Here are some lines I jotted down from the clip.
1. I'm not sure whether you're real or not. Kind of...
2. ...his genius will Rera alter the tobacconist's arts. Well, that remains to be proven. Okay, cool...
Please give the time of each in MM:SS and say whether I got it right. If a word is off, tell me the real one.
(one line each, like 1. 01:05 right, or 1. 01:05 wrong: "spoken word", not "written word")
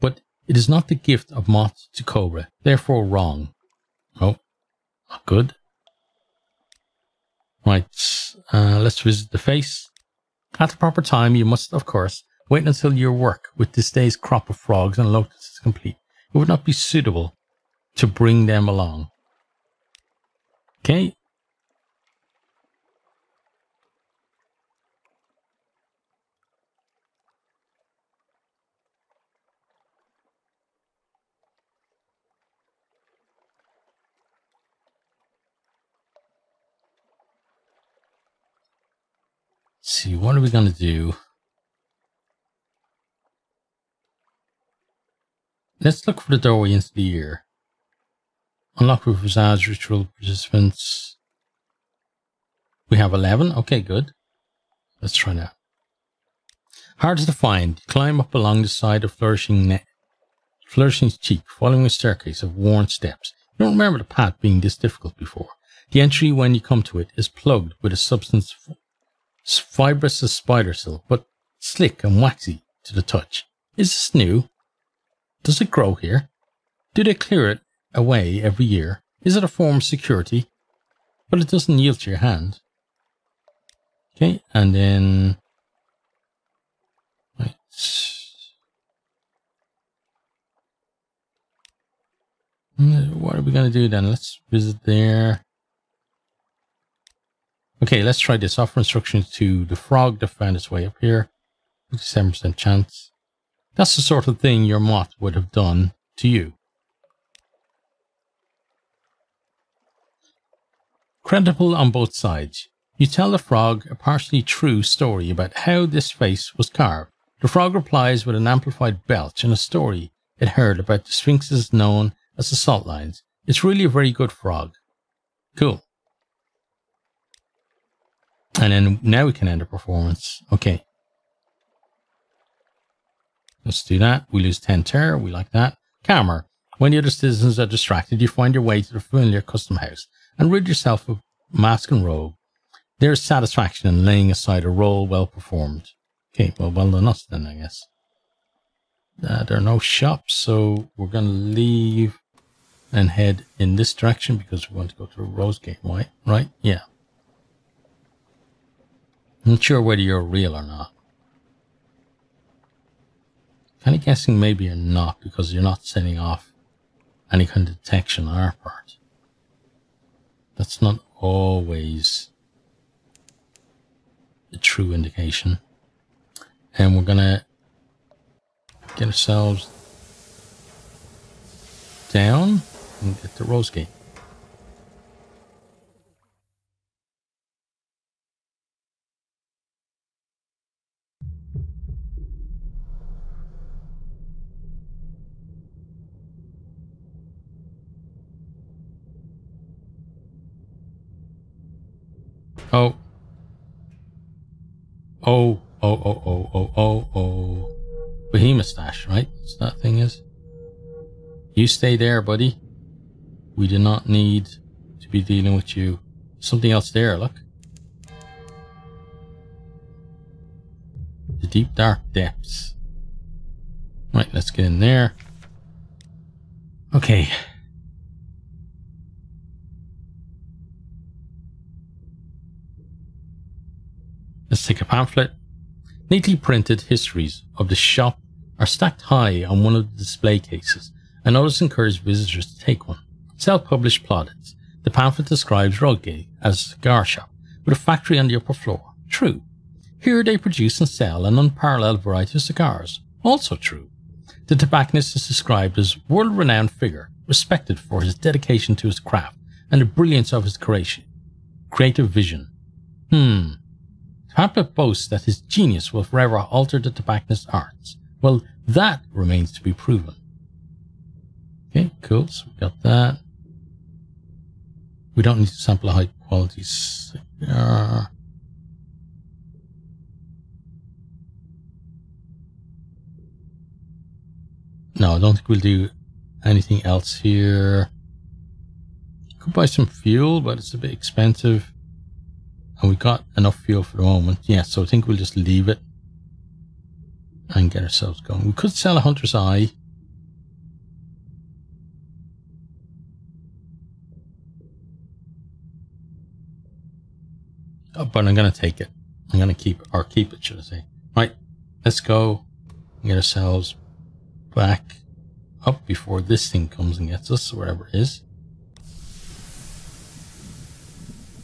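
1. 02:39 right
2. 04:25 right.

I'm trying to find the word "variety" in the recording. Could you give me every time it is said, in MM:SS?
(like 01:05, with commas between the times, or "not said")
04:12.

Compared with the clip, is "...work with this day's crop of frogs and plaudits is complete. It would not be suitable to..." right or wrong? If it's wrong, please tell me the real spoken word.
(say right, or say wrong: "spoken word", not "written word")
wrong: "locusts", not "plaudits".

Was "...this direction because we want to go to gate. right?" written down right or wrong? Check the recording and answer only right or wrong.
right.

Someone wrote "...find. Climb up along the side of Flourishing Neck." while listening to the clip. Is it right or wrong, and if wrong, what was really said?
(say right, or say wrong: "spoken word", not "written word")
right.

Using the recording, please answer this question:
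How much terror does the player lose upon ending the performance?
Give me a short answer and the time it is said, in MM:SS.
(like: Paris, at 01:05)
10, at 02:14.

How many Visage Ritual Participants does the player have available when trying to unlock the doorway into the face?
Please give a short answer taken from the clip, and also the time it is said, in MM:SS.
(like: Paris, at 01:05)
11, at 00:52.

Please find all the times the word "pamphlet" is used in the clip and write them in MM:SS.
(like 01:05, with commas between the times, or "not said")
03:54, 04:04, 04:24.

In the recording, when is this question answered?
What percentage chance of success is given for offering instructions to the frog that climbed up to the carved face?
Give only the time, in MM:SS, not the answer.
01:41.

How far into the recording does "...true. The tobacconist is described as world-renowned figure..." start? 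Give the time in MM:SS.
04:13.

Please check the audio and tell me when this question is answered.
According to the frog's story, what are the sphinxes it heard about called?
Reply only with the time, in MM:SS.
02:02.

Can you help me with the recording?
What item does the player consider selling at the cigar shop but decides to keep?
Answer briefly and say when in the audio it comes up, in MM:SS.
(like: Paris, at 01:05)
Hunter's Eye, at 04:59.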